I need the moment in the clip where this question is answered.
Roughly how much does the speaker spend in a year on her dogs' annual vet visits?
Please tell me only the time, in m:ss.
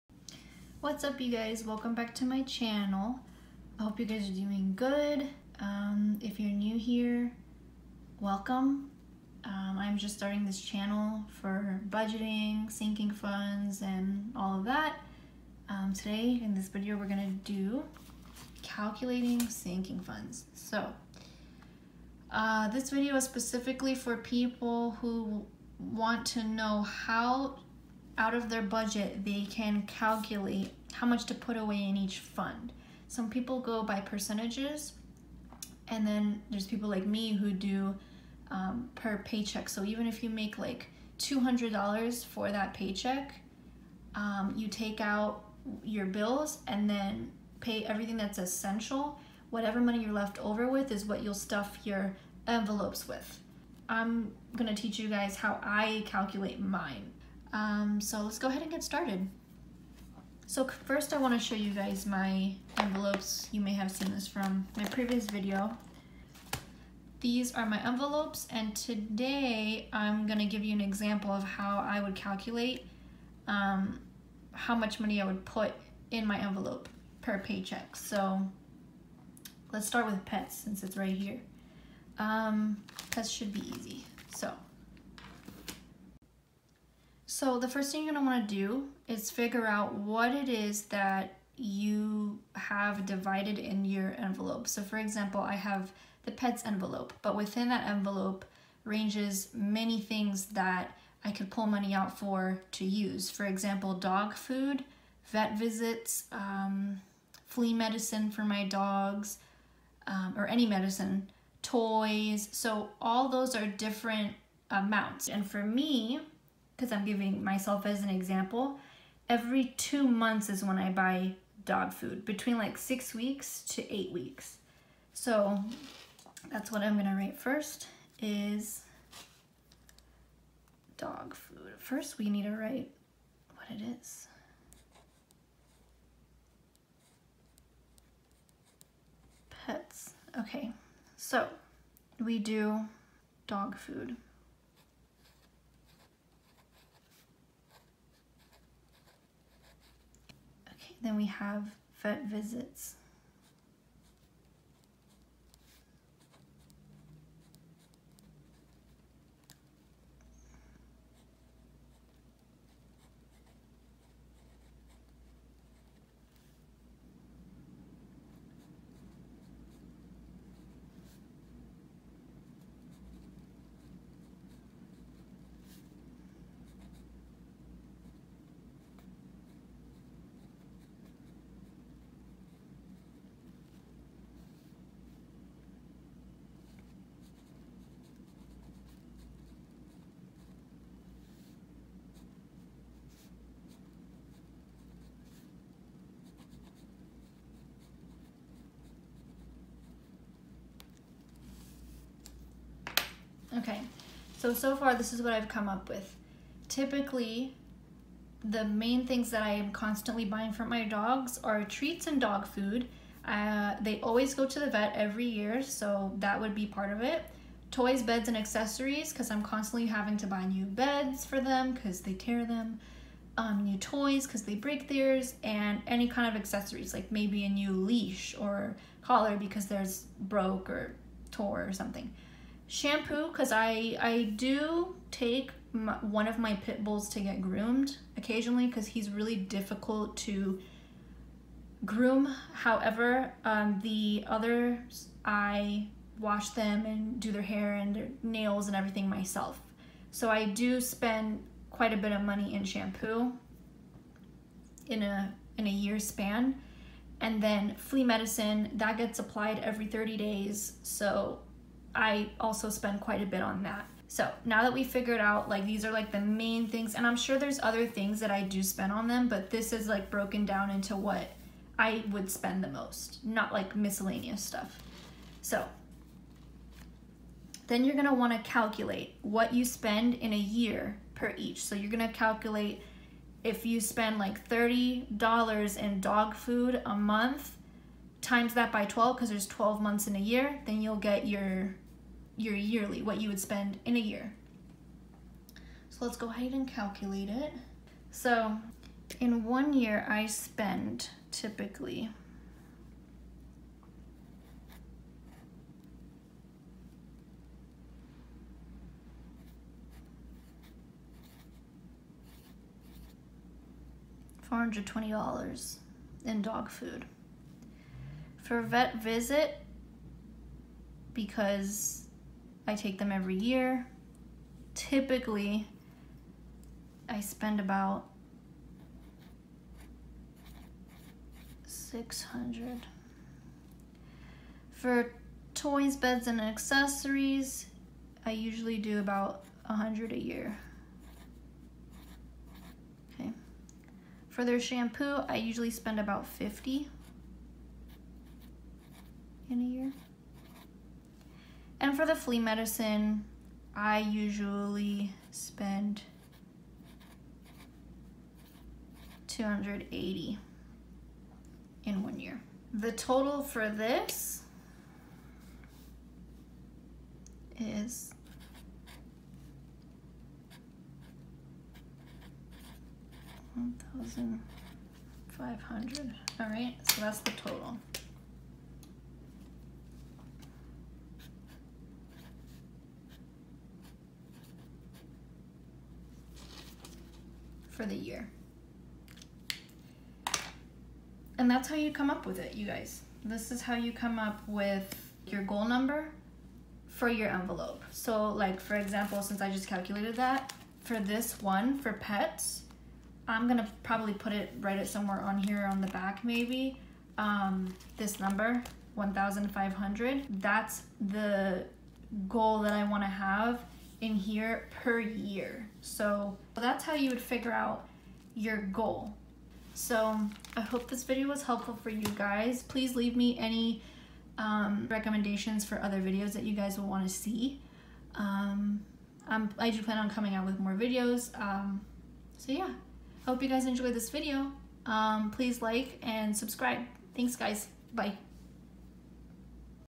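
5:31.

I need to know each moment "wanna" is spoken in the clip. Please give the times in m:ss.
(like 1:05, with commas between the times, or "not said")
1:28, 4:38, 6:52.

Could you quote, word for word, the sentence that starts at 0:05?
Um, if you're new here, welcome.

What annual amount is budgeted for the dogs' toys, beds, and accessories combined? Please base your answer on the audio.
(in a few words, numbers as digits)
$100.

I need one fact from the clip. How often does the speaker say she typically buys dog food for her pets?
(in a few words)
every two months.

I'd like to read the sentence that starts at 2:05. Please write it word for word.
So that's what I'm gonna write first is dog food.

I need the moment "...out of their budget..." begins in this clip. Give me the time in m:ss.
0:28.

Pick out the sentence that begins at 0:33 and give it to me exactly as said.
Some people go by percentages, and then there's people like me who do um, per paycheck.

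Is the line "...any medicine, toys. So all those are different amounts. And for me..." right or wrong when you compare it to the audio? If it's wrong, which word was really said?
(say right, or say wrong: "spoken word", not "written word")
right.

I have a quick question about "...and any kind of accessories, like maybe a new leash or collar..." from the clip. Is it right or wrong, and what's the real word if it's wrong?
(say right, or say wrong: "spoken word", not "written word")
right.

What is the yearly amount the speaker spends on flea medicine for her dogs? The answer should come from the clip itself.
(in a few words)
$280.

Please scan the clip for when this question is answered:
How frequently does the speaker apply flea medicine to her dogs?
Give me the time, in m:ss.
4:19.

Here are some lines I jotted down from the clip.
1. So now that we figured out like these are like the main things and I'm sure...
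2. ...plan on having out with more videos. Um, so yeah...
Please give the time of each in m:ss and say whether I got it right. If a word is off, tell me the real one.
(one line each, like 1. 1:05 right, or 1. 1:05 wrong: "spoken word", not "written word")
1. 4:24 right
2. 7:09 wrong: "coming", not "having".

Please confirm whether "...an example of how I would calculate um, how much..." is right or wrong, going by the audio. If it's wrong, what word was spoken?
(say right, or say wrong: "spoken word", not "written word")
right.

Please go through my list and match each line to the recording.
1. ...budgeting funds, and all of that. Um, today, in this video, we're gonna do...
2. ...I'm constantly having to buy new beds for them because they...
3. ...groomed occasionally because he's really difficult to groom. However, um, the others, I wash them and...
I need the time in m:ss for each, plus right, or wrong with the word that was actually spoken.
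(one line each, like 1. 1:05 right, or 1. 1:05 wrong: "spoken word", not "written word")
1. 0:12 wrong: "sinking", not "budgeting"
2. 3:39 right
3. 3:57 right.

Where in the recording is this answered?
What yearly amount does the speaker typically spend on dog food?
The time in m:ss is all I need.
5:14.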